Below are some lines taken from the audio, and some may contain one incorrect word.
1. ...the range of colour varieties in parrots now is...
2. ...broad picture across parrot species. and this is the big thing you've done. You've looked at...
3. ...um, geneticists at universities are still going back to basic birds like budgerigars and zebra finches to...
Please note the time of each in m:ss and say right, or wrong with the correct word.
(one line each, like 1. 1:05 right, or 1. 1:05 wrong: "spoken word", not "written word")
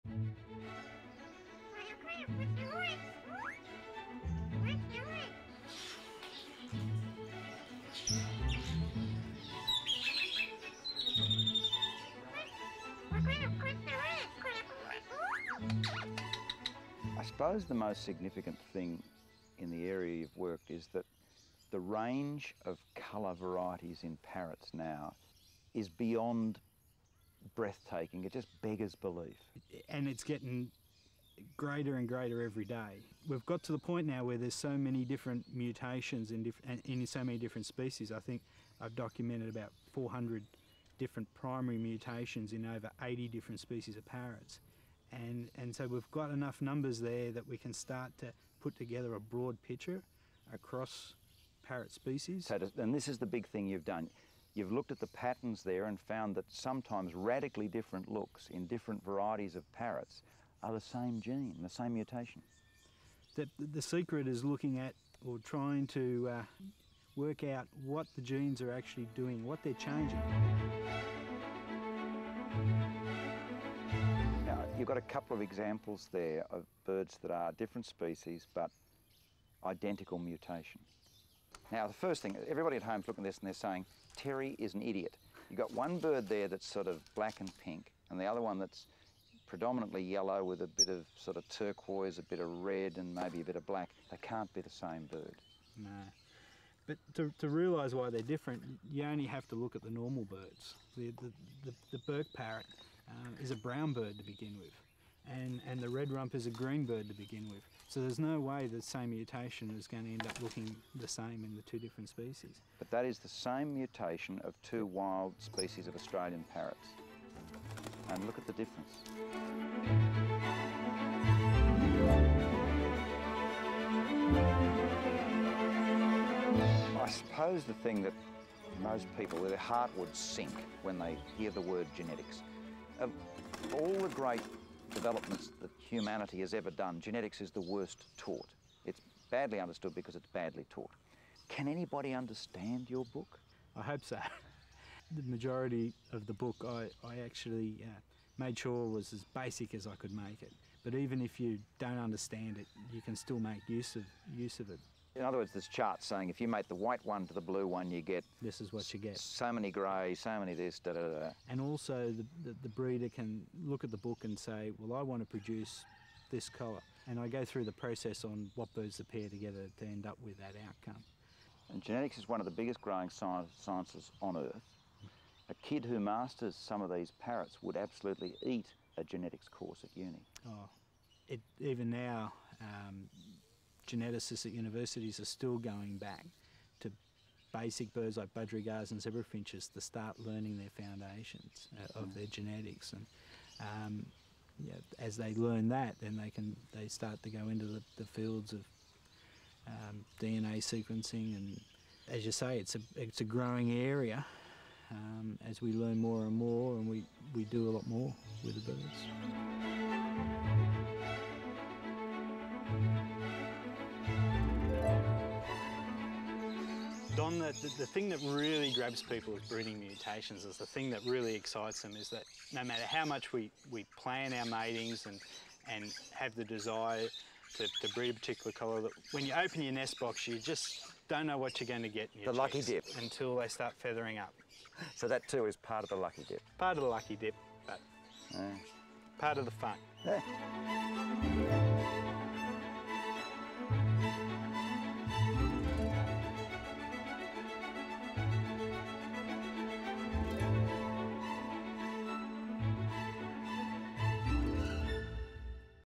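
1. 0:21 right
2. 0:49 right
3. 3:02 right.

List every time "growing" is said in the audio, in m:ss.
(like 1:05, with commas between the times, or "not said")
2:52, 3:23.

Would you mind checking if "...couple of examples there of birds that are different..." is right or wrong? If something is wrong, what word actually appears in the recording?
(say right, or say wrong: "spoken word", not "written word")
right.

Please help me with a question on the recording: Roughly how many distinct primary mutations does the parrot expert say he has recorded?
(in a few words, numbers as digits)
400.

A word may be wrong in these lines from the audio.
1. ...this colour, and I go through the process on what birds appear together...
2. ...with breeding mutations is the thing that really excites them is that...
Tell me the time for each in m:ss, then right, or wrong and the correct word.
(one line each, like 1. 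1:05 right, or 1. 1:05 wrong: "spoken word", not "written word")
1. 2:46 right
2. 3:39 right.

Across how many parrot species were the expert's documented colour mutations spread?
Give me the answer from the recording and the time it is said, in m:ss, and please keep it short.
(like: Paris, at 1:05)
over 80, at 0:42.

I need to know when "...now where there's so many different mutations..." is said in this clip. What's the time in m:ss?
0:34.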